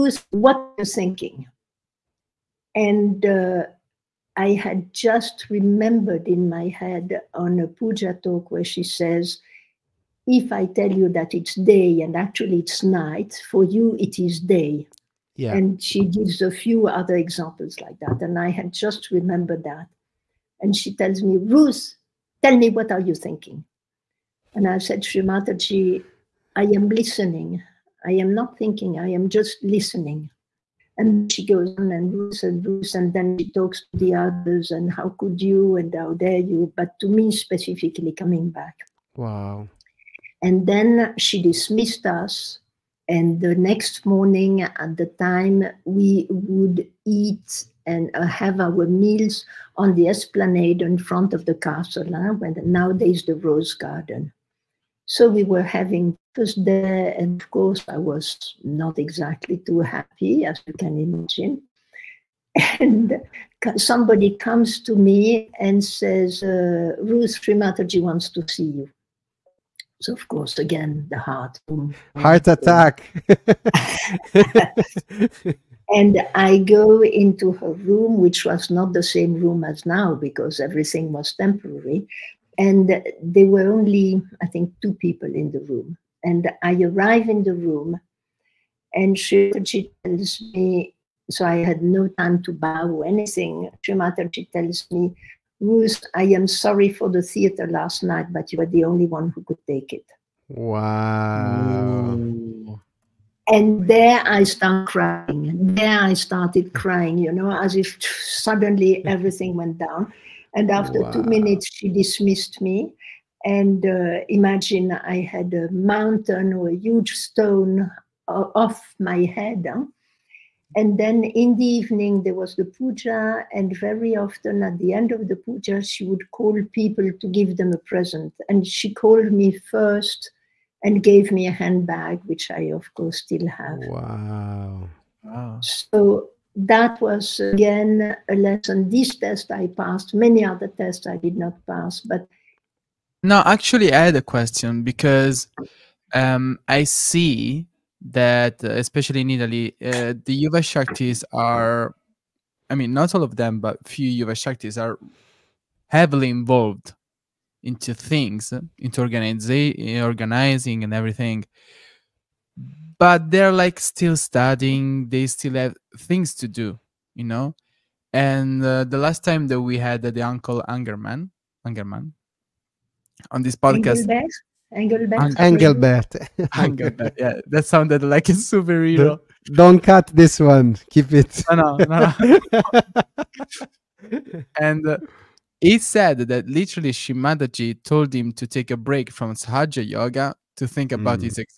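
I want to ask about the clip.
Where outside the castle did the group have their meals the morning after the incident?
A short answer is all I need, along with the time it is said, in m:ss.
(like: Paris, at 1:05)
The esplanade, at 0:50.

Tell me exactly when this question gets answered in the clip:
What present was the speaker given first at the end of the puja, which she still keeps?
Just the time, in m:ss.
2:11.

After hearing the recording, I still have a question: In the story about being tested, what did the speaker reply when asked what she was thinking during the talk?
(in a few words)
I am listening.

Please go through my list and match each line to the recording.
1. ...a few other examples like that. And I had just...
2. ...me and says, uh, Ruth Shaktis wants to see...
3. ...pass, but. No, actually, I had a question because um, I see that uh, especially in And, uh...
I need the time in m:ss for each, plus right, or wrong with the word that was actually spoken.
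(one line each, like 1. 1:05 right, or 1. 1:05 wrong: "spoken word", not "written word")
1. 0:16 right
2. 1:04 wrong: "Srimataji", not "Shaktis"
3. 2:21 wrong: "Italy", not "And".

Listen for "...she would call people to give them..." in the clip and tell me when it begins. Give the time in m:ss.
2:05.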